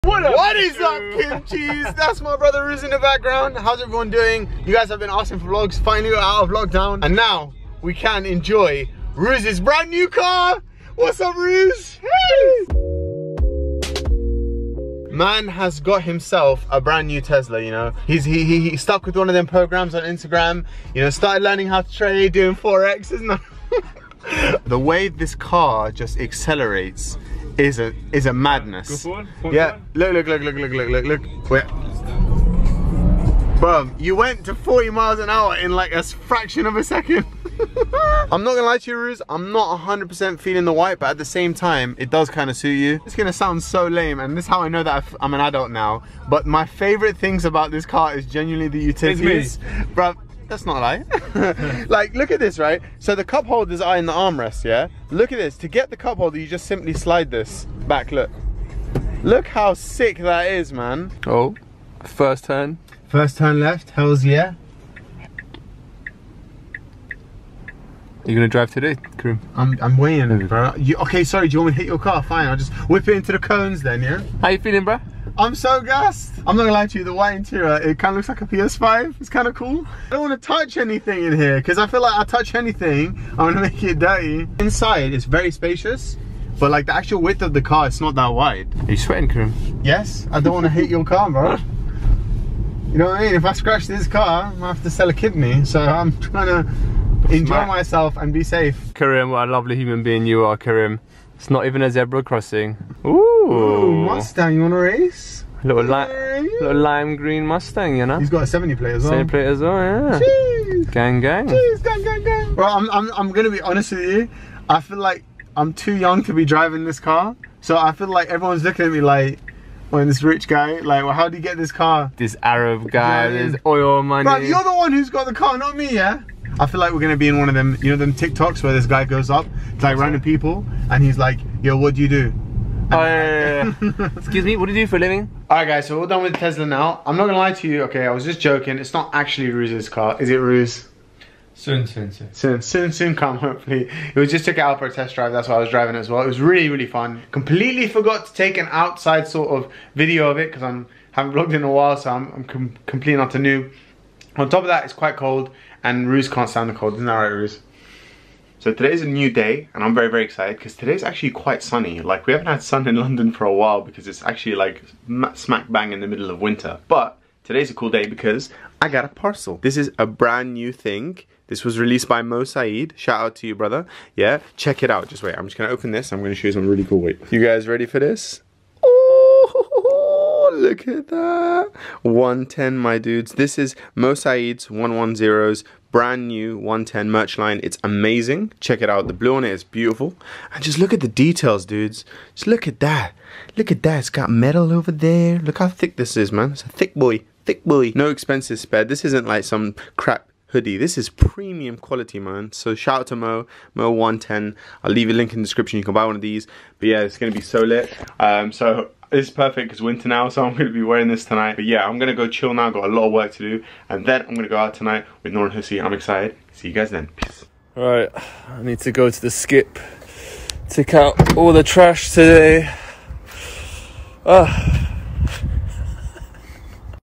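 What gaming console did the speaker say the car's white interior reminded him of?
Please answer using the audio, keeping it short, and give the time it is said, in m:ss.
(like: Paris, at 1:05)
PS5, at 1:18.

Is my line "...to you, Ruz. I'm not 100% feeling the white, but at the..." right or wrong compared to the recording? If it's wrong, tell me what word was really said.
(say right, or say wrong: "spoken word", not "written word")
right.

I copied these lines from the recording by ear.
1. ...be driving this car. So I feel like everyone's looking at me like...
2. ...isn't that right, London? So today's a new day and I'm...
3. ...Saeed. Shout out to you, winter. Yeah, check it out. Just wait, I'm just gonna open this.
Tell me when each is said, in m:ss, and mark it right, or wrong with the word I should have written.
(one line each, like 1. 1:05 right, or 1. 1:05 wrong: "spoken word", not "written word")
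1. 1:56 right
2. 2:36 wrong: "Ruse", not "London"
3. 2:52 wrong: "brother", not "winter".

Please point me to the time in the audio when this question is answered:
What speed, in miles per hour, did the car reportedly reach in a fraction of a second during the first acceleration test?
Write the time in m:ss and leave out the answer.
0:34.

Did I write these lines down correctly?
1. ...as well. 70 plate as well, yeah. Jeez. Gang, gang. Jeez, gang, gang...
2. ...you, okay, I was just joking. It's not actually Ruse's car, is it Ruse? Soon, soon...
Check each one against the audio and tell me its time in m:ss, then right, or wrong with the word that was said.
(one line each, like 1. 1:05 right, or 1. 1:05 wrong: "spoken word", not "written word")
1. 1:48 right
2. 2:17 right.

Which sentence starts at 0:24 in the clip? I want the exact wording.
the way this car just accelerates is a is a madness.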